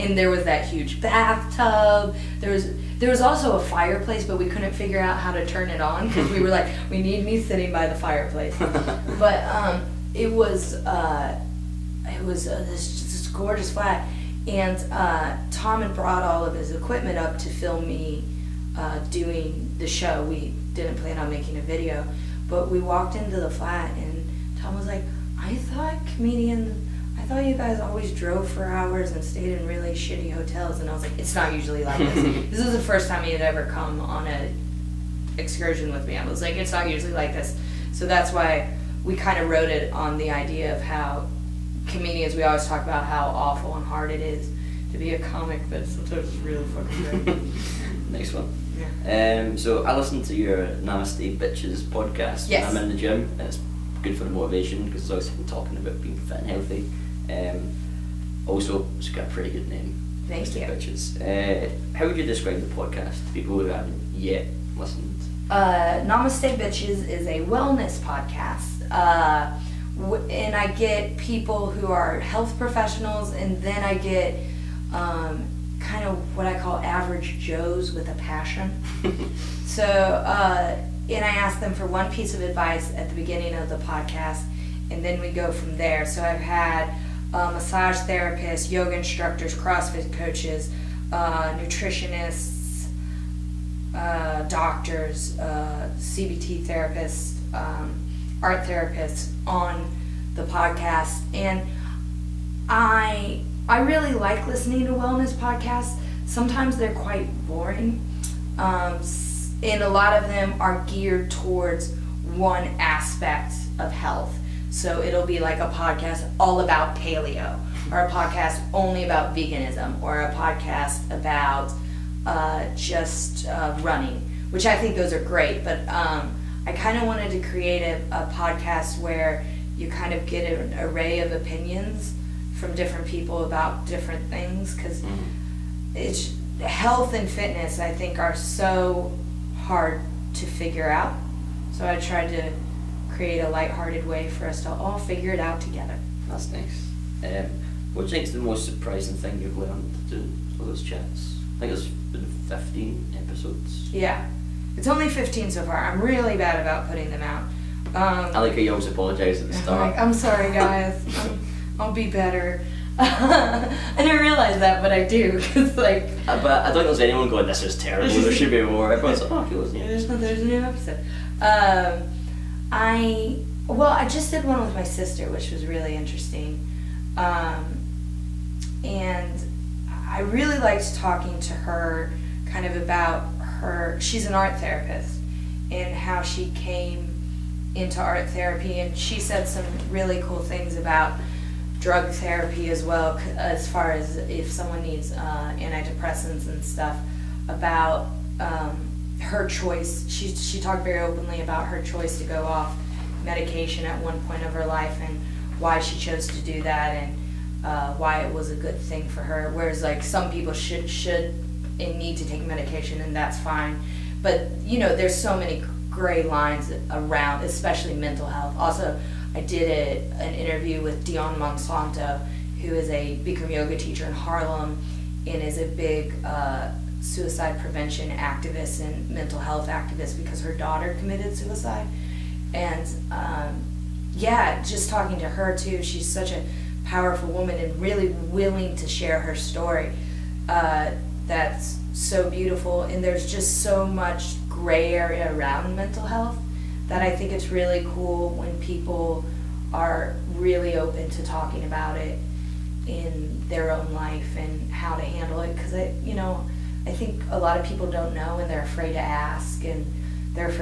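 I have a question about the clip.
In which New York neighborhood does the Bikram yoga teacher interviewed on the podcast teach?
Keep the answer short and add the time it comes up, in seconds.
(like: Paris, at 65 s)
Harlem, at 224 s.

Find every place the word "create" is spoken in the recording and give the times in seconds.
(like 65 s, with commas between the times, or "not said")
127 s, 143 s.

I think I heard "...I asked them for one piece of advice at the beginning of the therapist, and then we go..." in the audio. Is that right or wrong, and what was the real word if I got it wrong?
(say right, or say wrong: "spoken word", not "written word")
wrong: "podcast", not "therapist".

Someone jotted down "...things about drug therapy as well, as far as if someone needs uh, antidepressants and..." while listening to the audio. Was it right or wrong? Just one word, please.
right.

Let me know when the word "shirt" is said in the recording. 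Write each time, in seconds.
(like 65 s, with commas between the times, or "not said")
not said.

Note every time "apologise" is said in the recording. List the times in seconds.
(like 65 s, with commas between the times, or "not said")
158 s.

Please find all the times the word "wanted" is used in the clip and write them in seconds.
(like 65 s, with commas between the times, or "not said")
127 s.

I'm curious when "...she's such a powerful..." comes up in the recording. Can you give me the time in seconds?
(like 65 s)
235 s.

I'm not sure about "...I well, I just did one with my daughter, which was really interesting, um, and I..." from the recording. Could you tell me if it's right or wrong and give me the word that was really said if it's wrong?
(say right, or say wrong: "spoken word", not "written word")
wrong: "sister", not "daughter".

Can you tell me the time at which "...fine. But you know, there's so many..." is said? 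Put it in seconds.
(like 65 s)
213 s.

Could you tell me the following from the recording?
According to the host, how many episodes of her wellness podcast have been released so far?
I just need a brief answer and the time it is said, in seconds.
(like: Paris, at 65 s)
15, at 152 s.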